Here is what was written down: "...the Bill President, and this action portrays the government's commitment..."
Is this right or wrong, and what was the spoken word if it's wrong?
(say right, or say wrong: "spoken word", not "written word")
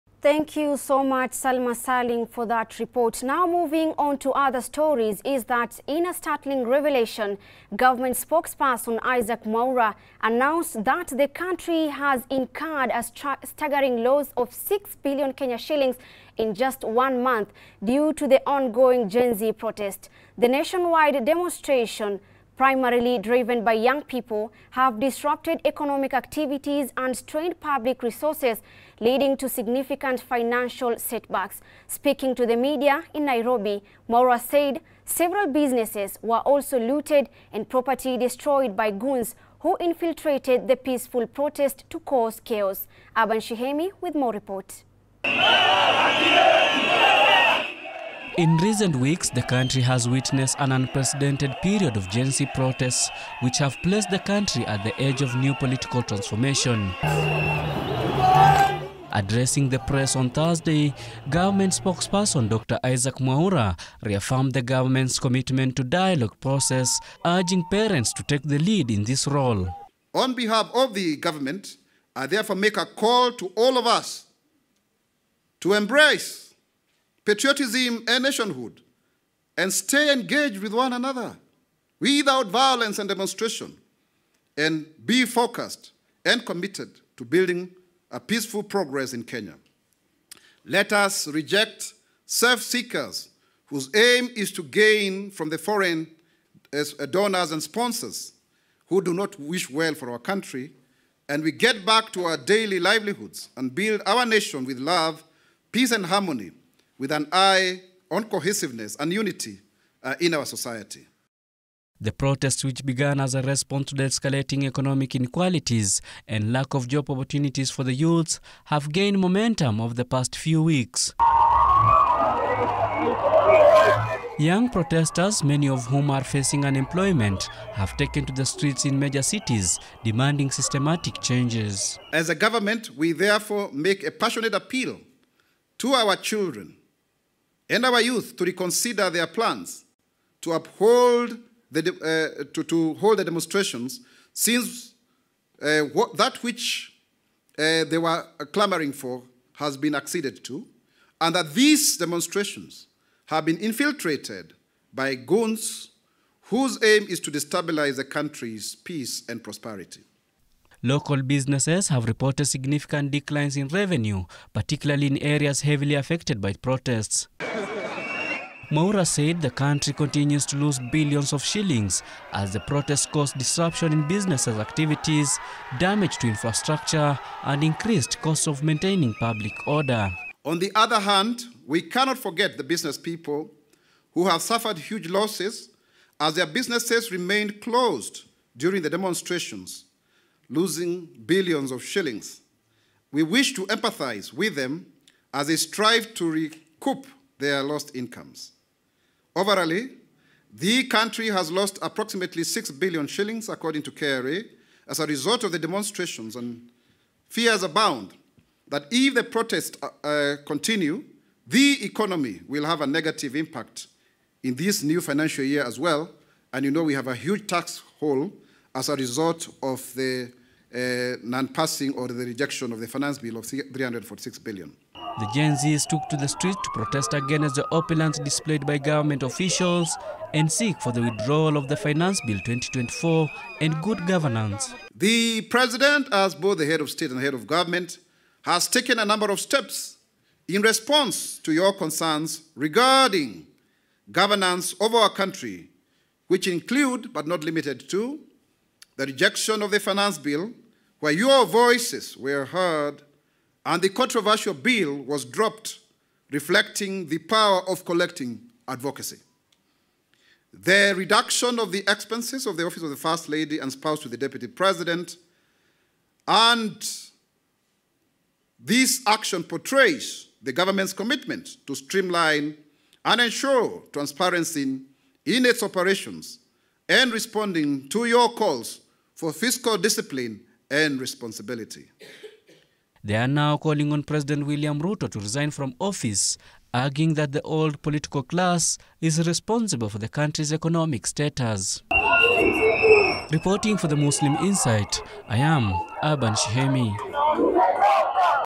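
wrong: "Deputy", not "Bill".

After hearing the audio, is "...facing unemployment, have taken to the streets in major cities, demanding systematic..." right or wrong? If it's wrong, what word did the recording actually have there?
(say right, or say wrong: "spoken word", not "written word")
right.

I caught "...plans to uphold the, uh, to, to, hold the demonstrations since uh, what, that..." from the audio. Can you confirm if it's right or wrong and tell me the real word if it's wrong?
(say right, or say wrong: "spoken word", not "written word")
right.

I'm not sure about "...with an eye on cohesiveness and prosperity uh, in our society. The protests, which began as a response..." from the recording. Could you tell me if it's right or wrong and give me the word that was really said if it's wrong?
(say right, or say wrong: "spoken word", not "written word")
wrong: "unity", not "prosperity".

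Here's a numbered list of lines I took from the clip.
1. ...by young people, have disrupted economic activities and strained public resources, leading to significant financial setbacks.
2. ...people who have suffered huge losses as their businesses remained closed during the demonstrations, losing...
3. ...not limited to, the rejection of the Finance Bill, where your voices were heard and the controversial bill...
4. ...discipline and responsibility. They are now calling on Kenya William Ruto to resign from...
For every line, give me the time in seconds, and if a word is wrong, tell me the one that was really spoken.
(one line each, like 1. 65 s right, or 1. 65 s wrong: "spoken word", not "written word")
1. 23 s right
2. 182 s right
3. 247 s right
4. 279 s wrong: "President", not "Kenya".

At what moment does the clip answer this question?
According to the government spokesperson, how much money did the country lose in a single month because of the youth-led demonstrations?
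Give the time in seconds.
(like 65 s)
14 s.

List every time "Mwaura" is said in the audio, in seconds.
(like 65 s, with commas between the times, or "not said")
9 s, 34 s, 63 s, 168 s.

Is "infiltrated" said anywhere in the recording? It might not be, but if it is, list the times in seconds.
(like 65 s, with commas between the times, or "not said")
39 s, 153 s.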